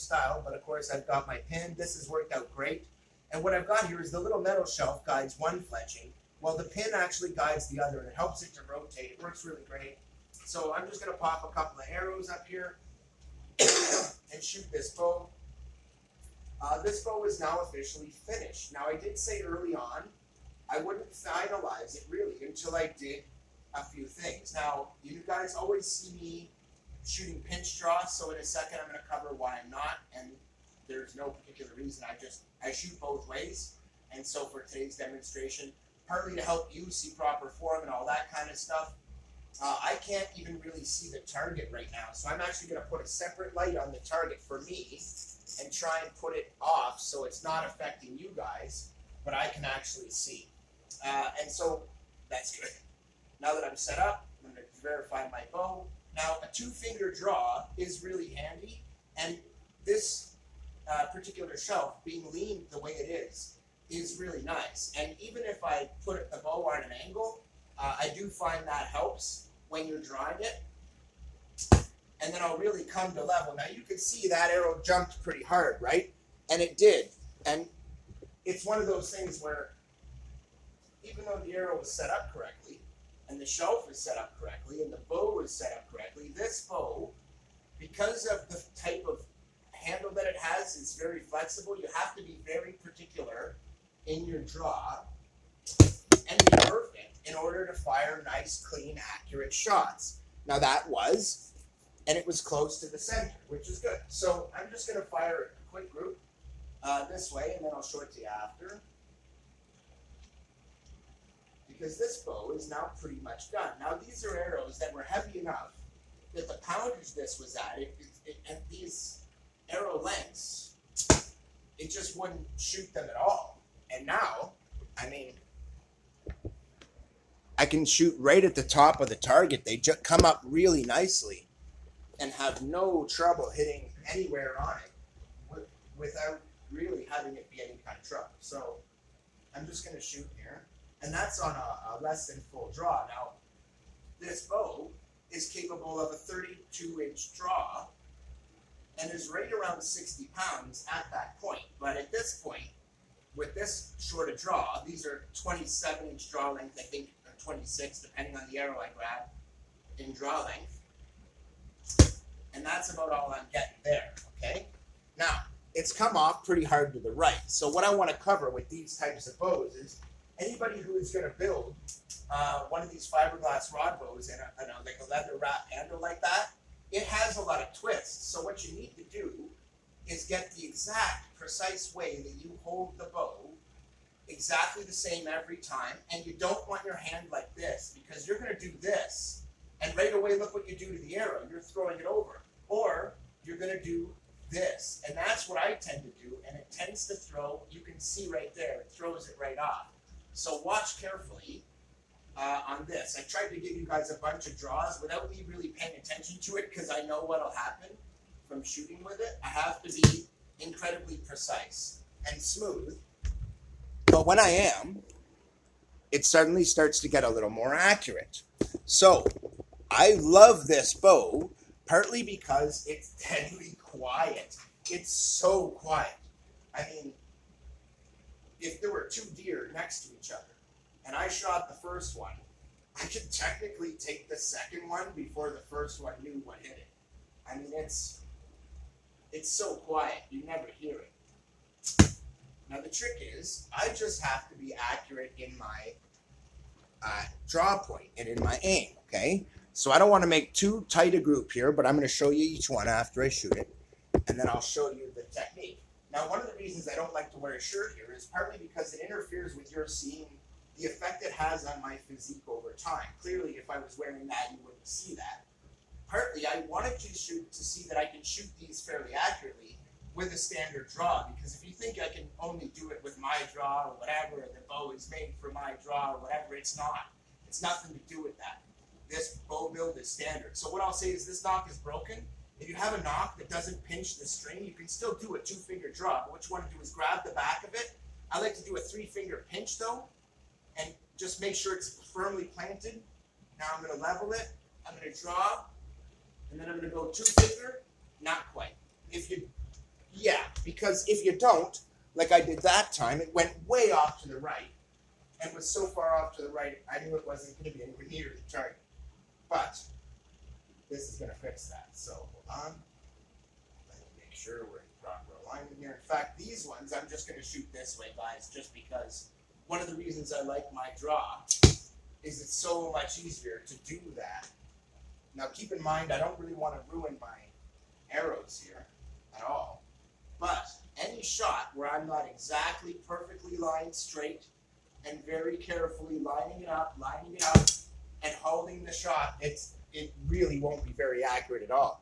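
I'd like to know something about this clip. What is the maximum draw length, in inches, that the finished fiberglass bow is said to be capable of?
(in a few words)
32 inch.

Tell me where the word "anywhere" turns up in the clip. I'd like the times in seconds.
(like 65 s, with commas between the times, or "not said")
134 s, 307 s.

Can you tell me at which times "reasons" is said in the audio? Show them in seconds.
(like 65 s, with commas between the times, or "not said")
31 s, 256 s, 319 s.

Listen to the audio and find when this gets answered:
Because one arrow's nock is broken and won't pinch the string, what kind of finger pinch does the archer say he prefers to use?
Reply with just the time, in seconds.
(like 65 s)
288 s.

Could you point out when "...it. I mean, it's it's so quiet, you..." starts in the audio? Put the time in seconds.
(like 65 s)
236 s.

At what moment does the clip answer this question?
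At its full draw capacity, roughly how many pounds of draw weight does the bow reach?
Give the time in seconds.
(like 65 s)
149 s.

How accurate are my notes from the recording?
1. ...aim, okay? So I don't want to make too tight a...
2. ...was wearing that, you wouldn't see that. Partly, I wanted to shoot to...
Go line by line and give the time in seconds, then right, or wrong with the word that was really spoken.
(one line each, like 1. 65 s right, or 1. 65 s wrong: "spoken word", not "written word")
1. 248 s right
2. 263 s right.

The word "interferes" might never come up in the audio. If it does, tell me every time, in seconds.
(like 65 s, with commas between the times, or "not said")
259 s.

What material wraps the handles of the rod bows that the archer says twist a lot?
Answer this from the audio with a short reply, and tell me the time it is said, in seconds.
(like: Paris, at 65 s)
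leather, at 175 s.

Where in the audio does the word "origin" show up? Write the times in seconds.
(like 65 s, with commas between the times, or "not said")
not said.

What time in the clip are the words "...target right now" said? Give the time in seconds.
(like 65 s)
41 s.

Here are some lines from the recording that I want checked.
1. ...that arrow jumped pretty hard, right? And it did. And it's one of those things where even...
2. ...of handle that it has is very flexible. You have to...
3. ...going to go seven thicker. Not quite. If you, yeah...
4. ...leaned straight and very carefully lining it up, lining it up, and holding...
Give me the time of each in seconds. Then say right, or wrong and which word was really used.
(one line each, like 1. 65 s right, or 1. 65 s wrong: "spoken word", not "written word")
1. 74 s right
2. 89 s right
3. 296 s wrong: "two", not "seven"
4. 333 s wrong: "lined", not "leaned".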